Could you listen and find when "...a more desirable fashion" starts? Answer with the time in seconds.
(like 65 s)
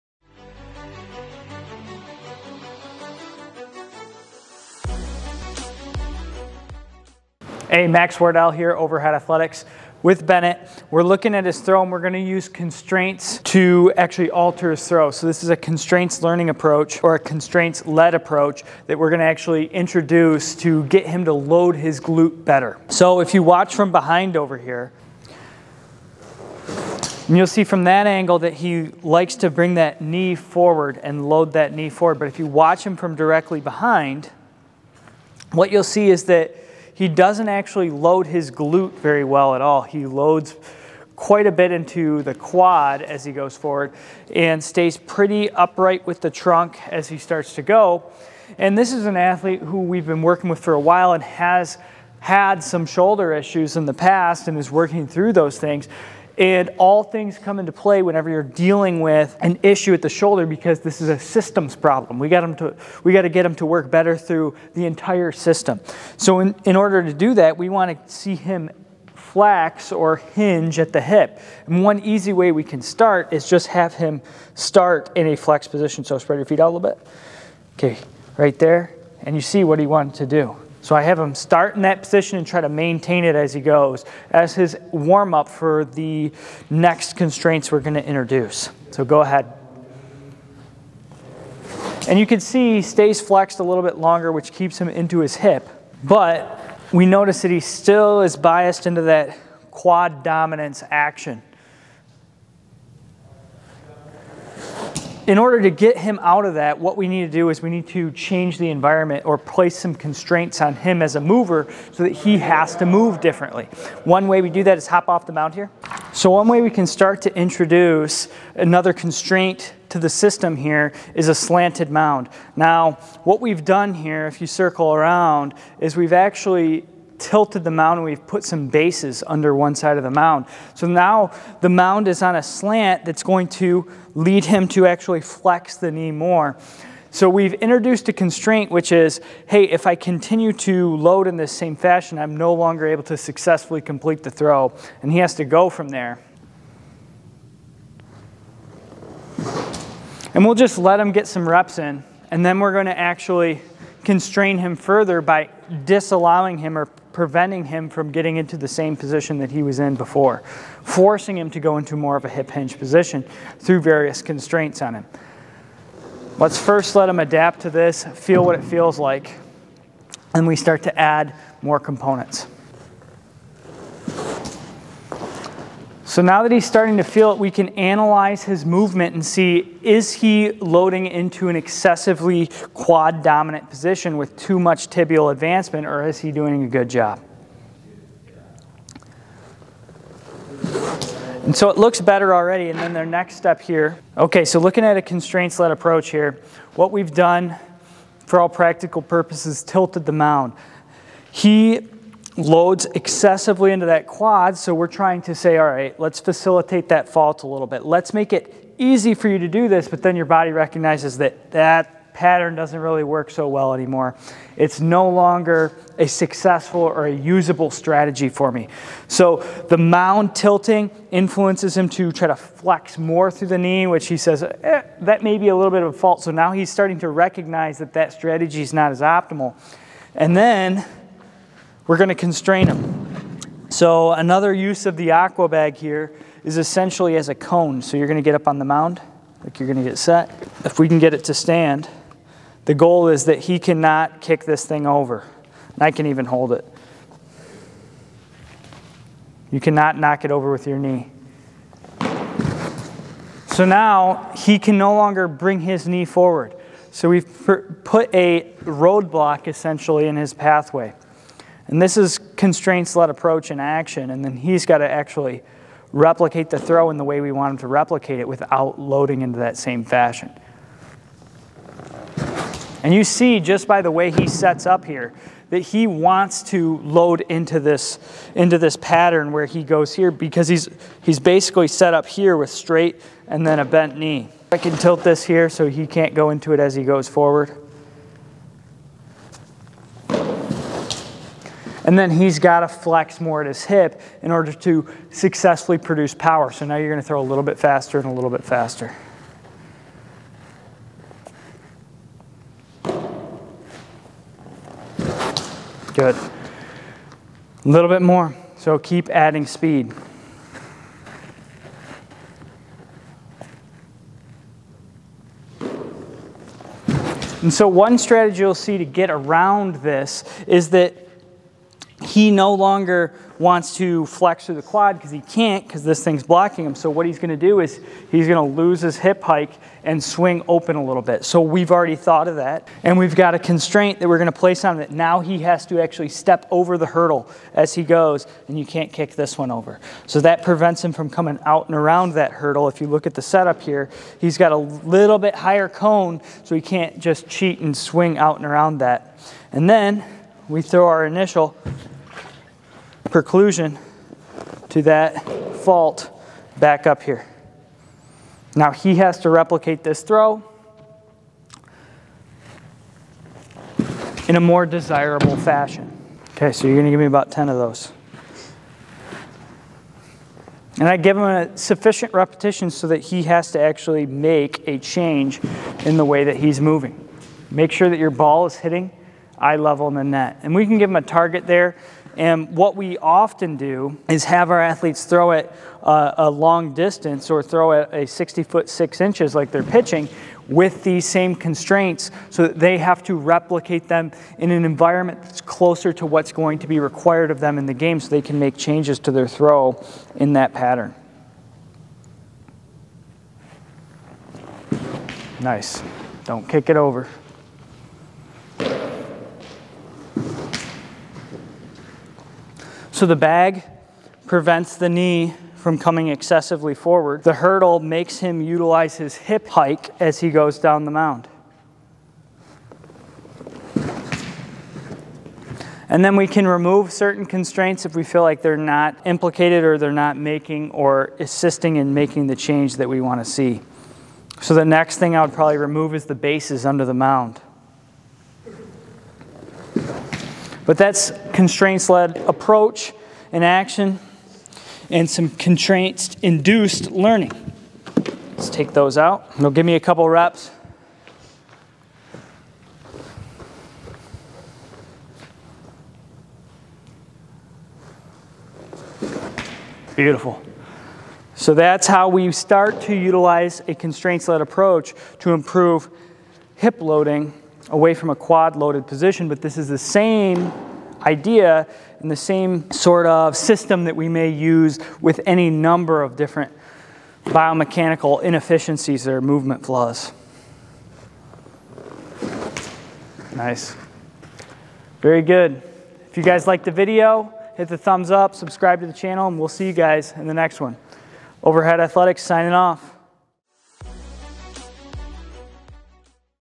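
364 s.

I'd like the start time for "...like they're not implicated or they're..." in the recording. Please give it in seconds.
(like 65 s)
428 s.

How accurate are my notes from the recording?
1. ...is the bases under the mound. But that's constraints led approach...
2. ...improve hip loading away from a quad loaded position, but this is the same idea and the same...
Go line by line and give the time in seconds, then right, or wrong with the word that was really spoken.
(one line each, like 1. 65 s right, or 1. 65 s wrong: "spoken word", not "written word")
1. 435 s right
2. 465 s right.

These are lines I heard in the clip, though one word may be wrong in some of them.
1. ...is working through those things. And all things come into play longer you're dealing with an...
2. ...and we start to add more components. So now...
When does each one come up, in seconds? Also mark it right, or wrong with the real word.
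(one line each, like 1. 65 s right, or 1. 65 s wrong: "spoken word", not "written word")
1. 54 s wrong: "whenever", not "longer"
2. 170 s right.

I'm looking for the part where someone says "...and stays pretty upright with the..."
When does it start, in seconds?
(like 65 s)
44 s.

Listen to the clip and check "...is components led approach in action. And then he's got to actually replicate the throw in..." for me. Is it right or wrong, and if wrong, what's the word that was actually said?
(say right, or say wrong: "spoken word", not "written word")
wrong: "constraints", not "components".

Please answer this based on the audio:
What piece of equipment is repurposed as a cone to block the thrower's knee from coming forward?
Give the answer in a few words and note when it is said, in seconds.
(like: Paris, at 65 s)
Aqua bag, at 235 s.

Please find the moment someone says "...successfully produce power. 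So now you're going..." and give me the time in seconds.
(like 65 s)
295 s.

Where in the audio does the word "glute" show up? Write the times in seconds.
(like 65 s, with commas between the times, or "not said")
22 s, 38 s.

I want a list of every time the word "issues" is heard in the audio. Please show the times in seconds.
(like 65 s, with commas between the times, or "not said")
53 s, 59 s.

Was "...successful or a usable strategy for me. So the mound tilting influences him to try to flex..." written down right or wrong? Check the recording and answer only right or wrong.
right.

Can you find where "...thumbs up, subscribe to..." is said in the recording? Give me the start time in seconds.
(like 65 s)
487 s.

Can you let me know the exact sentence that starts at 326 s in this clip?
So what he's going to do is he's going to lose his hip hike and swing open a little bit.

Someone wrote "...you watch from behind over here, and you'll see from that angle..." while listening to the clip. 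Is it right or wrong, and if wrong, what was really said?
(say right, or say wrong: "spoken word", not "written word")
right.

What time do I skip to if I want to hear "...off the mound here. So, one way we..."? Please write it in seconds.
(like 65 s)
115 s.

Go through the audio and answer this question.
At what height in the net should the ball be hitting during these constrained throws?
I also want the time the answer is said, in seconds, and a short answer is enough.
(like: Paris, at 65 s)
Eye level, at 379 s.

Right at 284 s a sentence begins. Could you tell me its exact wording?
I can tilt this here so he can't go into it as he goes forward.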